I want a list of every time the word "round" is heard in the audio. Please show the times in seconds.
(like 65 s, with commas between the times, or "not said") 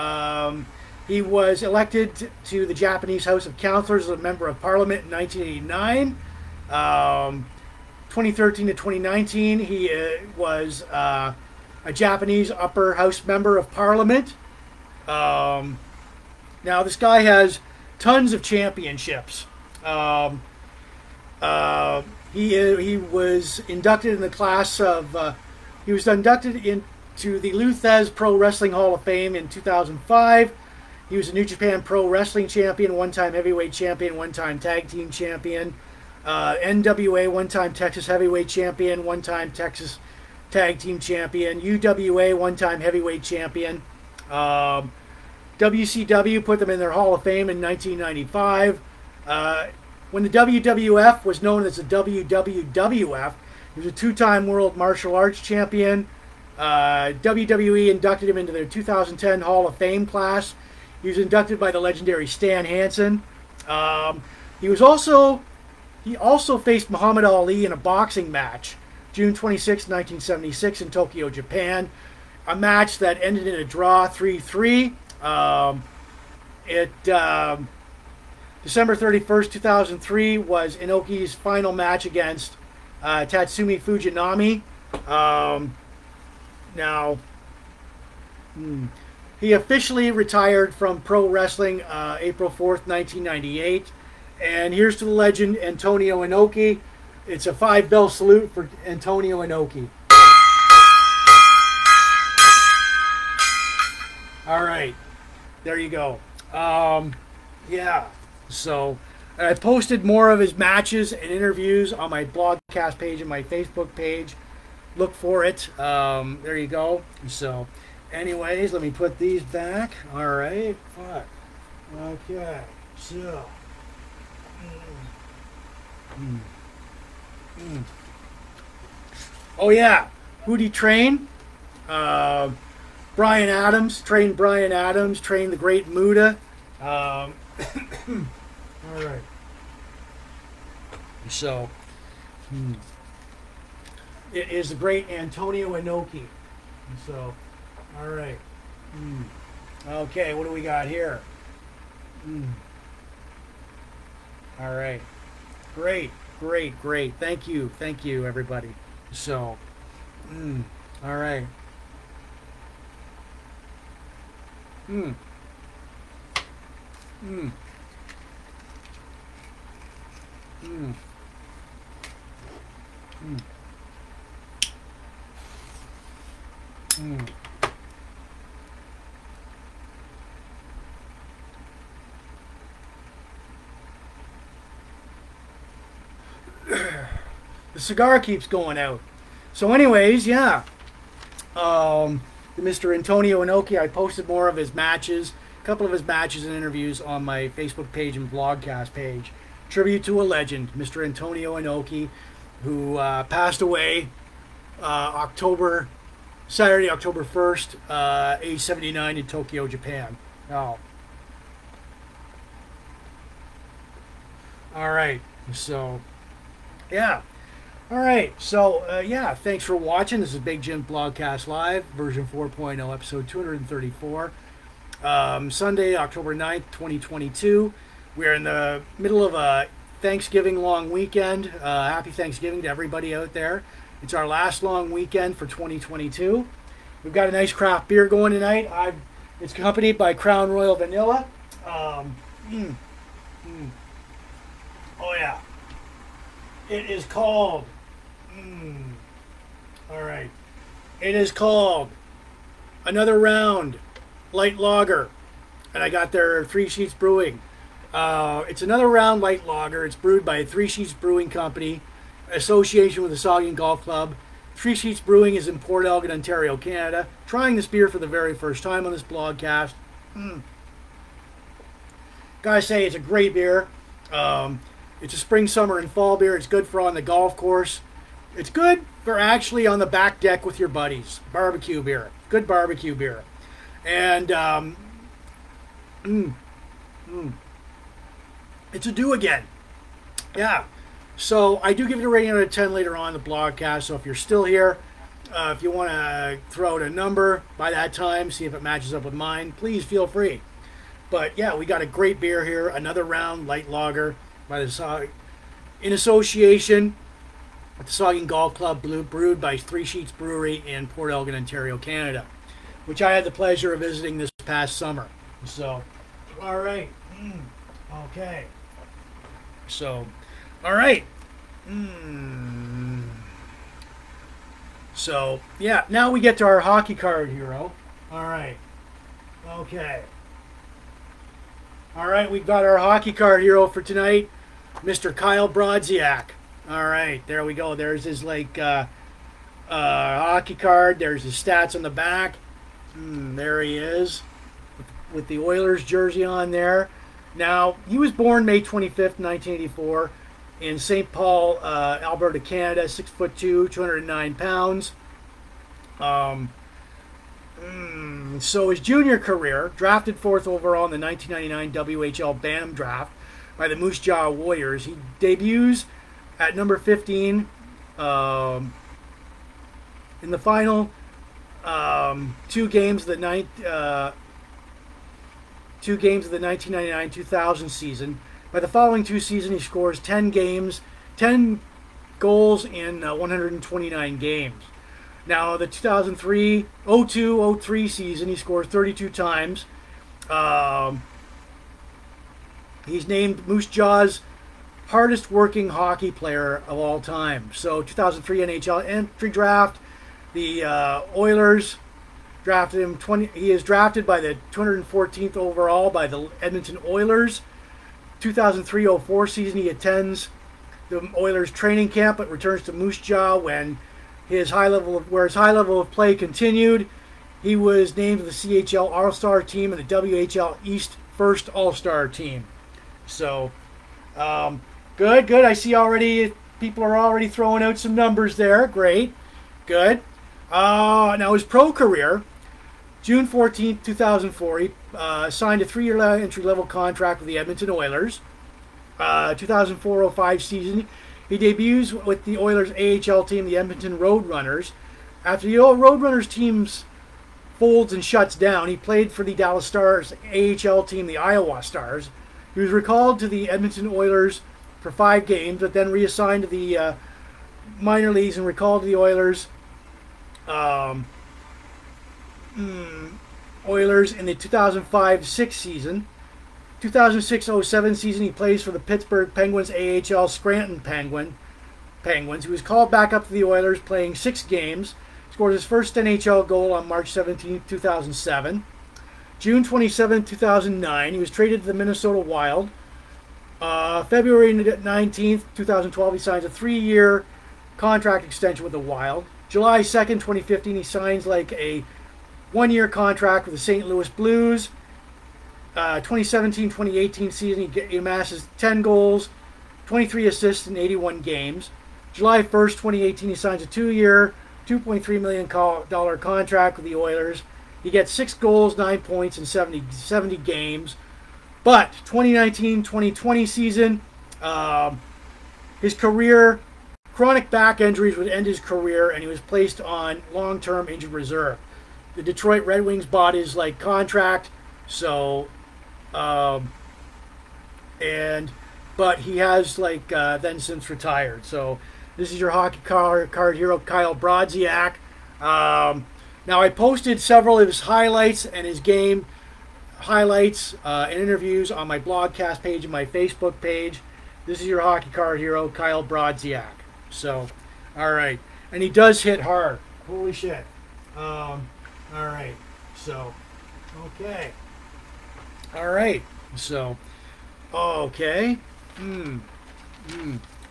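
253 s, 258 s, 303 s.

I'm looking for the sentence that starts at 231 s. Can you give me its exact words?
Uh, happy Thanksgiving to everybody out there.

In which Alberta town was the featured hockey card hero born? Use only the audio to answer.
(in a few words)
St. Paul.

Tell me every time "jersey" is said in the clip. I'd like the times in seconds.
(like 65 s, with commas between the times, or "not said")
345 s.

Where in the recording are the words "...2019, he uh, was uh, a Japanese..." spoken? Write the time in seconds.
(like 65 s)
8 s.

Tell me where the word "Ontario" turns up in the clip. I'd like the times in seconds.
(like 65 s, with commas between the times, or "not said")
266 s, 311 s.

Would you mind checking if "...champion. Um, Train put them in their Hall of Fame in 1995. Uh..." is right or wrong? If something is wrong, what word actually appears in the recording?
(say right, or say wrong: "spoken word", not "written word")
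wrong: "WCW", not "Train".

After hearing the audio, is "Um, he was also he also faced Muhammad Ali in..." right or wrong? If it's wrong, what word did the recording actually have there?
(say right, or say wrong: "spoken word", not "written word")
right.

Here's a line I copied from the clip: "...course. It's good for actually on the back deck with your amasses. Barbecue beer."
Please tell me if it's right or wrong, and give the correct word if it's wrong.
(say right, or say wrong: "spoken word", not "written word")
wrong: "buddies", not "amasses".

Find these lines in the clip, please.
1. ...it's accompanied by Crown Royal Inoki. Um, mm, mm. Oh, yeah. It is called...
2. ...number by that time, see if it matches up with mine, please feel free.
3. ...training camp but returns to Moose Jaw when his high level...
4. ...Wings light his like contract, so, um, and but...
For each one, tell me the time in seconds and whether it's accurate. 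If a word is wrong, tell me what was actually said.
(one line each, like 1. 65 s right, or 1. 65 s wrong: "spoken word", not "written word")
1. 239 s wrong: "Vanilla", not "Inoki"
2. 296 s right
3. 411 s right
4. 522 s wrong: "bought", not "light".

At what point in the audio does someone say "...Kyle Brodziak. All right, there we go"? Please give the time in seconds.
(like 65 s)
335 s.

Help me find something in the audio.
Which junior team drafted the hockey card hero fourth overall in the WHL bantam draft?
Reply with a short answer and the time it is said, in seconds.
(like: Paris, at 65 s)
Moose Jaw Warriors, at 363 s.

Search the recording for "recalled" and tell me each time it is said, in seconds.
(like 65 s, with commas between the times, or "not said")
452 s, 458 s.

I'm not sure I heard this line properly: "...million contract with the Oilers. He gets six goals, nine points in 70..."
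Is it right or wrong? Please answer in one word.
right.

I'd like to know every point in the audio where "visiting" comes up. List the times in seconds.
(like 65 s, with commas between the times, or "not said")
313 s.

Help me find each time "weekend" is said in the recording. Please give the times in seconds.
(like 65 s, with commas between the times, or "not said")
230 s, 234 s.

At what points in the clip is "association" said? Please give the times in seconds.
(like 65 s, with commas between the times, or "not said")
262 s, 305 s.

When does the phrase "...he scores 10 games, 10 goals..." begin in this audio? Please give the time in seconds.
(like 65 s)
379 s.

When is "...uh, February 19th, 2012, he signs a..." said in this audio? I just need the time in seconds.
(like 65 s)
483 s.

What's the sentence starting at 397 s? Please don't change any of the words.
So 2003 NHL entry draft, the uh, Oilers drafted him 20 he is drafted by the 214th overall by the Edmonton Oilers.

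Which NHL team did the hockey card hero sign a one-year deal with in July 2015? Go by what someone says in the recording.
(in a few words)
St. Louis Blues.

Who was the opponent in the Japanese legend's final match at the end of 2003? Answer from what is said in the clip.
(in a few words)
Tatsumi Fujinami.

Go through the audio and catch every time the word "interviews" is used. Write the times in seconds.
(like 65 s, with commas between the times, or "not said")
111 s, 196 s, 541 s.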